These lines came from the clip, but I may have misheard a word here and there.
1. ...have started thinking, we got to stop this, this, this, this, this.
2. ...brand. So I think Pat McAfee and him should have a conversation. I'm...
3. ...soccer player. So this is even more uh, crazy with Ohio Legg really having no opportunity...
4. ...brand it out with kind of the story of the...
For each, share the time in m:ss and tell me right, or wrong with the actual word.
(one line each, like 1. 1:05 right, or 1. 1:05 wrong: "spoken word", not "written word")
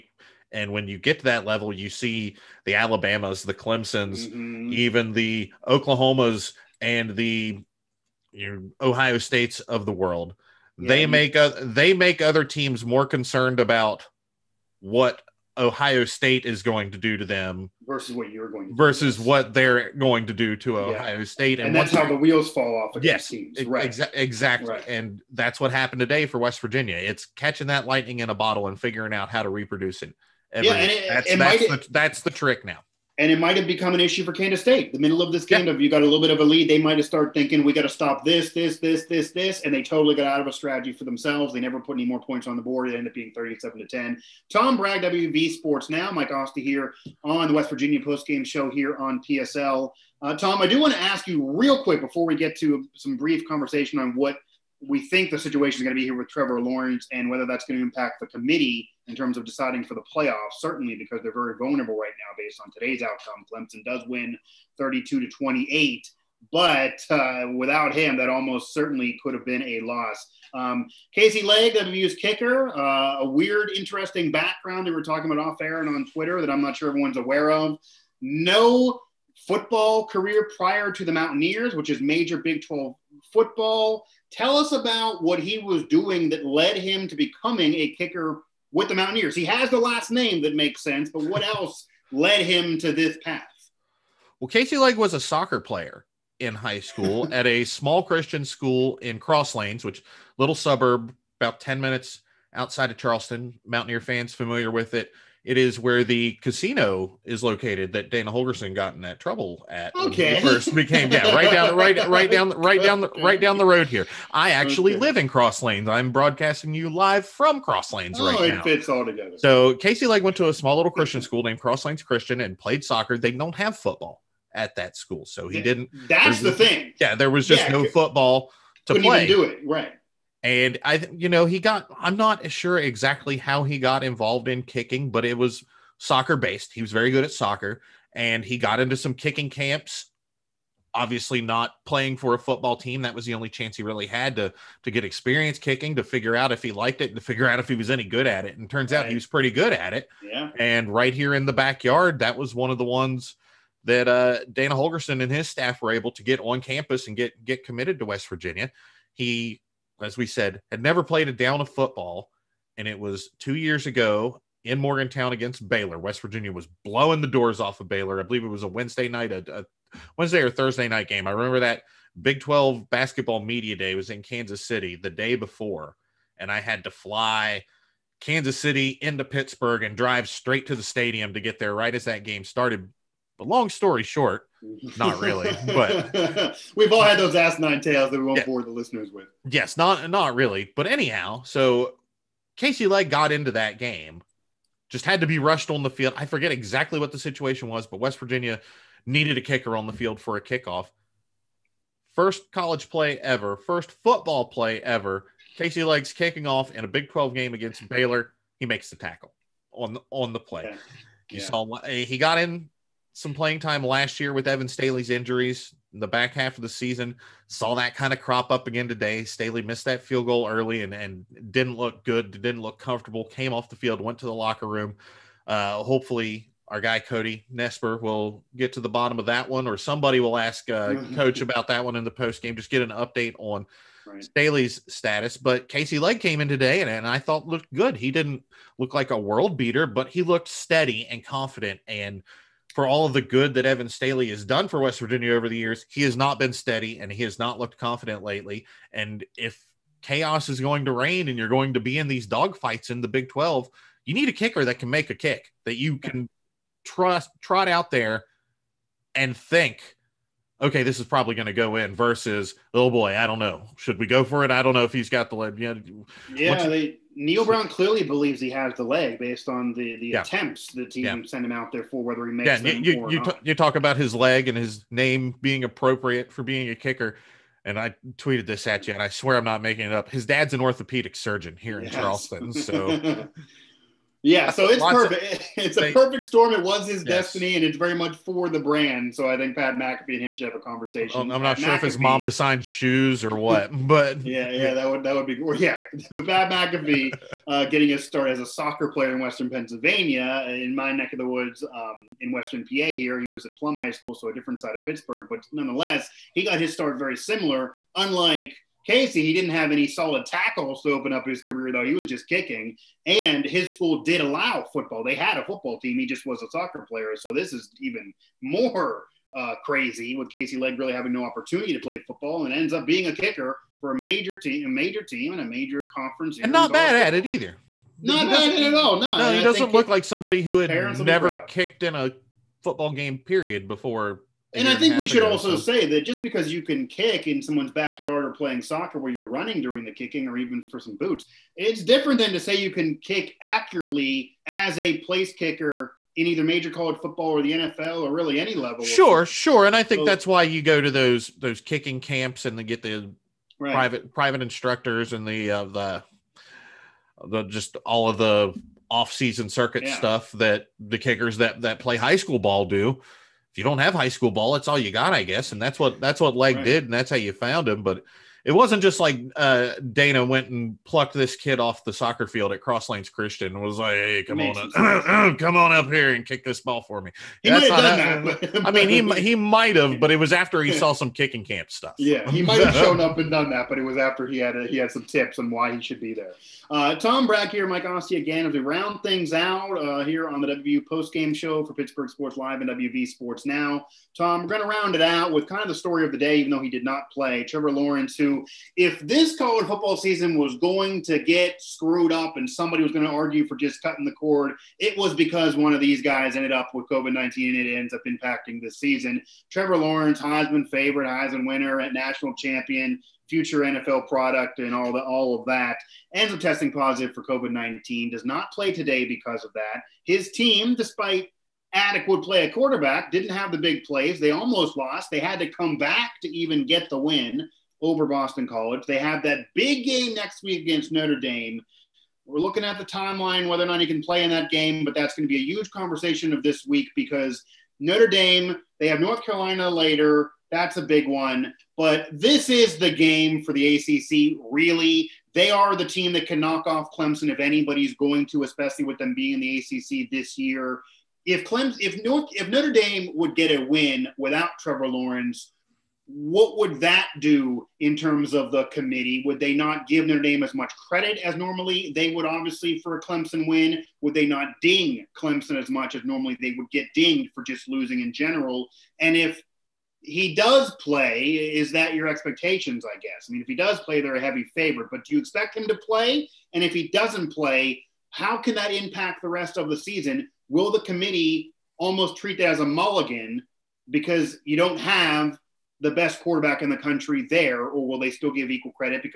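1. 0:36 right
2. 4:48 right
3. 5:16 wrong: "Casey", not "Ohio"
4. 6:34 wrong: "round", not "brand".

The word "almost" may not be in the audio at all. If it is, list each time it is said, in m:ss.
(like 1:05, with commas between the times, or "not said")
1:08, 7:04, 8:01.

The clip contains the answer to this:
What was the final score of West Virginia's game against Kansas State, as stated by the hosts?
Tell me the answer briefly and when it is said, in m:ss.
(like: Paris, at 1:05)
37-10, at 0:43.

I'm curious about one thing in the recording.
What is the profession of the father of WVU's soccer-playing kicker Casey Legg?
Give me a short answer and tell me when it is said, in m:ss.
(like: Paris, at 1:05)
Orthopedic surgeon, at 4:40.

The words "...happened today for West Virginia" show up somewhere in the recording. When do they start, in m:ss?
0:25.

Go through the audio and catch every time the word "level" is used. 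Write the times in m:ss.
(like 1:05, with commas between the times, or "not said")
0:01, 5:48.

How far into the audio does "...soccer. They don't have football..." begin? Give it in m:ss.
2:02.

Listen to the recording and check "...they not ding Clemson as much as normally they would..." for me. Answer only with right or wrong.
right.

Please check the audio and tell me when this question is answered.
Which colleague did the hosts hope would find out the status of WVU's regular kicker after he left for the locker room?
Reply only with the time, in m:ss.
3:47.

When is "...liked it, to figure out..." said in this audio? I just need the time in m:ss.
2:26.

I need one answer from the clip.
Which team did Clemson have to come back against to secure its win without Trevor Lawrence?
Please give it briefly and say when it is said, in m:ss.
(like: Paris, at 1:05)
Boston College, at 7:08.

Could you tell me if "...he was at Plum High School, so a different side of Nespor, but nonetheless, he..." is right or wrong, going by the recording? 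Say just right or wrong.
wrong.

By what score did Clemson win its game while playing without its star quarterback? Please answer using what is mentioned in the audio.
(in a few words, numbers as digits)
32-28.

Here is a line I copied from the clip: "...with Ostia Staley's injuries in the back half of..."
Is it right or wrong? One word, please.
wrong.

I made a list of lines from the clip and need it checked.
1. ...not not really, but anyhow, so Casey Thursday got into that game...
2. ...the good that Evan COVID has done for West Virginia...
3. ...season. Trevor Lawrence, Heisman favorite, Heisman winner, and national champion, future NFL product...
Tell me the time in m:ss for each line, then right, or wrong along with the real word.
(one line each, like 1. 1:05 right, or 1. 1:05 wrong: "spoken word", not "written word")
1. 3:09 wrong: "Legg", not "Thursday"
2. 4:03 wrong: "Staley", not "COVID"
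3. 6:48 right.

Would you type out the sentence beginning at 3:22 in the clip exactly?
First college play ever, first football play ever.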